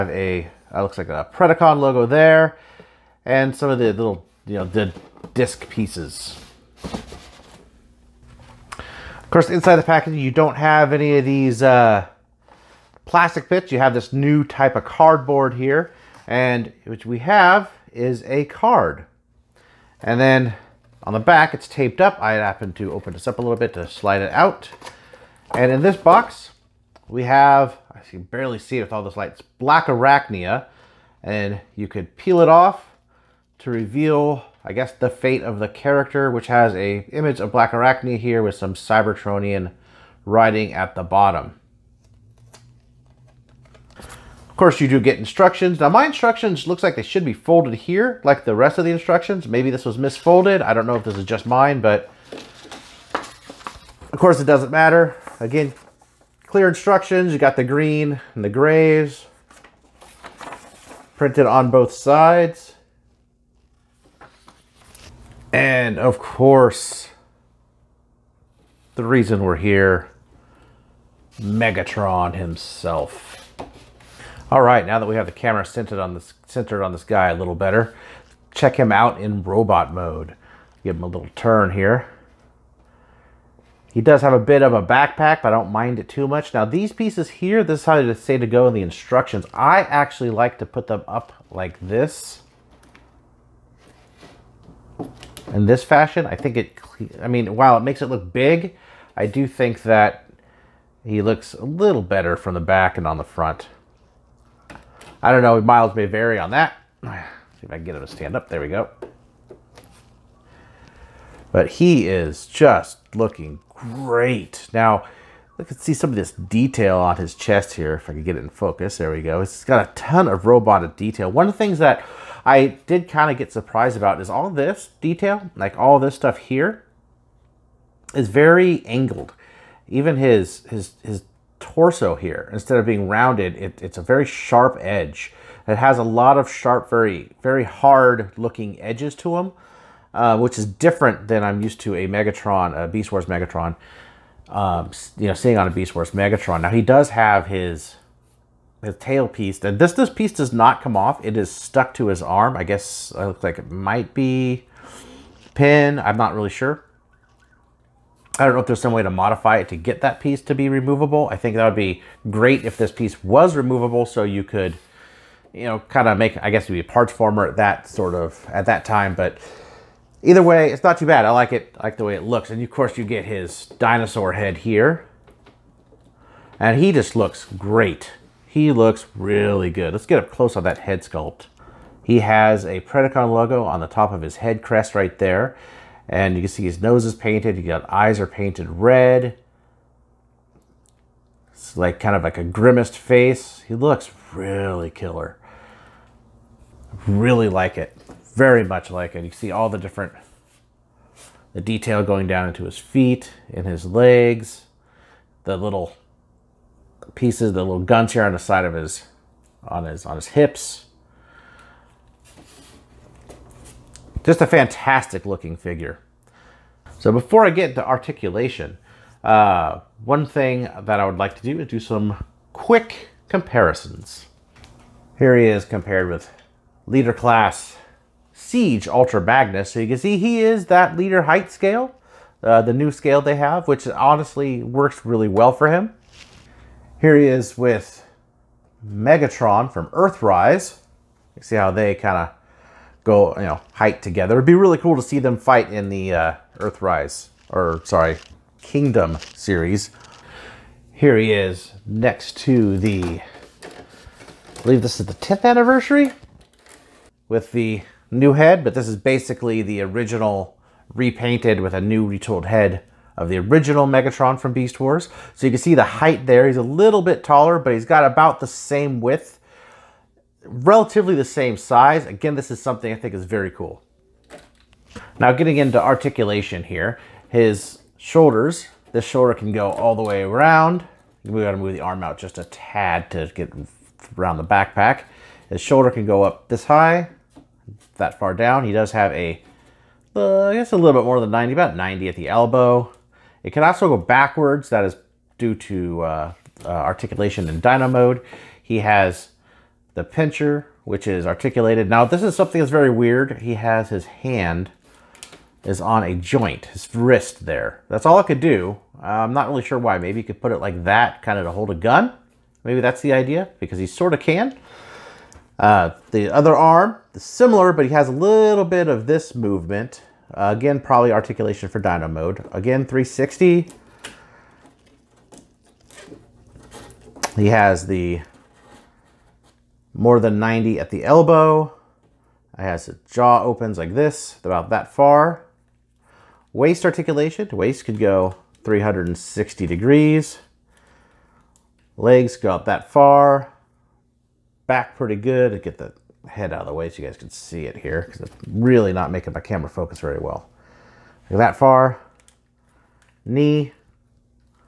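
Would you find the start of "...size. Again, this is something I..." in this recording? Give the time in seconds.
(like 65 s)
271 s.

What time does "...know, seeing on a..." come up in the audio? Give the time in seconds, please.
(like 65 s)
145 s.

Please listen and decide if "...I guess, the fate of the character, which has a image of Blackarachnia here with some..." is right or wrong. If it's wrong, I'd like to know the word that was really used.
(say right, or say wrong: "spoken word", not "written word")
right.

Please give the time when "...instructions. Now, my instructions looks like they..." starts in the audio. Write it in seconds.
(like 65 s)
45 s.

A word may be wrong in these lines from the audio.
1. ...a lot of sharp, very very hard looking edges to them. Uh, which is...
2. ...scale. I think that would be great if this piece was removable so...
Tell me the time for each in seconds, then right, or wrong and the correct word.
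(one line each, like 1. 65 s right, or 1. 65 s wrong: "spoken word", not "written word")
1. 135 s right
2. 160 s wrong: "removable", not "scale".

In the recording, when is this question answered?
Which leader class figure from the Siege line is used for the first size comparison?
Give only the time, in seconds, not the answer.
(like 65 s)
228 s.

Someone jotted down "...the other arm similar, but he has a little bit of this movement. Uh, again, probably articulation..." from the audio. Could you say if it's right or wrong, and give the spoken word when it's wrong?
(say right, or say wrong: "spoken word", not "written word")
right.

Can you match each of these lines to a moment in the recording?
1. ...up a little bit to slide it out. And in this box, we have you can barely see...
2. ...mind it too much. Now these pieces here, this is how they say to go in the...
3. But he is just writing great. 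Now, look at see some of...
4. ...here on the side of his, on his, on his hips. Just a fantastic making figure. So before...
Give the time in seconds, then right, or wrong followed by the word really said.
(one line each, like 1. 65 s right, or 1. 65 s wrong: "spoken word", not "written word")
1. 23 s right
2. 85 s right
3. 111 s wrong: "looking", not "writing"
4. 208 s wrong: "looking", not "making".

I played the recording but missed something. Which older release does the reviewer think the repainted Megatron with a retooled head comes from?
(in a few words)
10th anniversary.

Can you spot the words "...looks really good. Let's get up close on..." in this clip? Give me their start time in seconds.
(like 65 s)
178 s.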